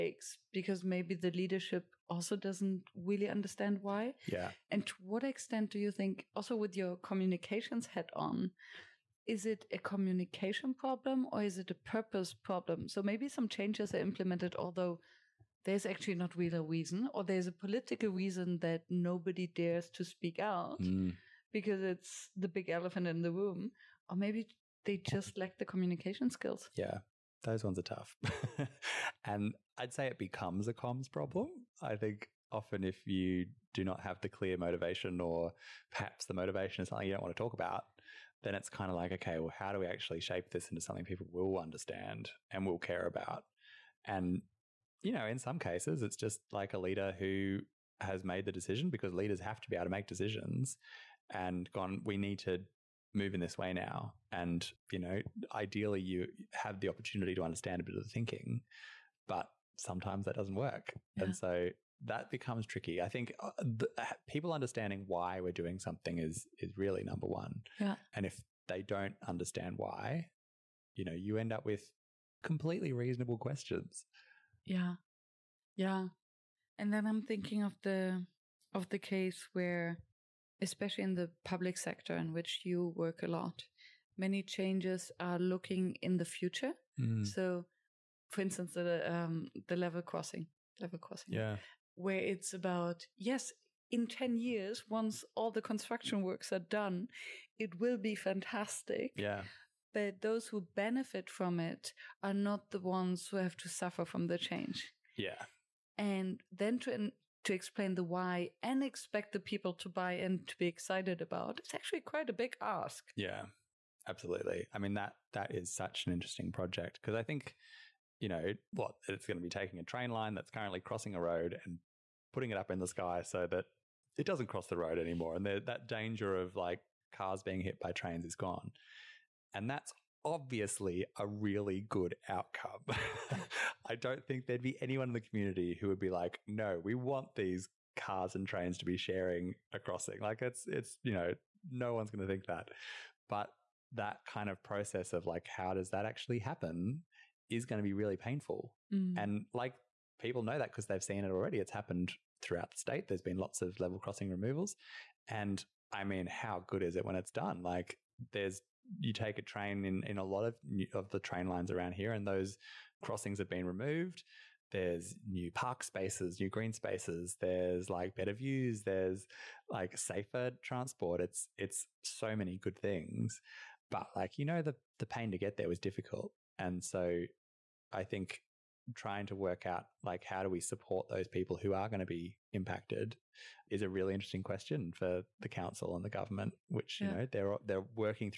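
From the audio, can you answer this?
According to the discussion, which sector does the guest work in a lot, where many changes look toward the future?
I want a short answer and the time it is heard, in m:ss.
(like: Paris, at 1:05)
public sector, at 1:21.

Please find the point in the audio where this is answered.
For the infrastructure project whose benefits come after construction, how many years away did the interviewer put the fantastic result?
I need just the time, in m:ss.
1:34.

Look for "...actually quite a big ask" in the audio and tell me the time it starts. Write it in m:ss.
1:51.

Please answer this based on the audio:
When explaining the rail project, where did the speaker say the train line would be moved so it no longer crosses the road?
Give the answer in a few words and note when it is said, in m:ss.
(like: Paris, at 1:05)
up in the sky, at 2:02.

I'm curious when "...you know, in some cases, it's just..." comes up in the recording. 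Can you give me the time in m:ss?
0:45.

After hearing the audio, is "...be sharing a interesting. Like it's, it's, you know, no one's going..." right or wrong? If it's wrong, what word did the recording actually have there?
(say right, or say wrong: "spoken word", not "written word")
wrong: "crossing", not "interesting".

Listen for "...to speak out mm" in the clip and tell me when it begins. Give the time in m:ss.
0:19.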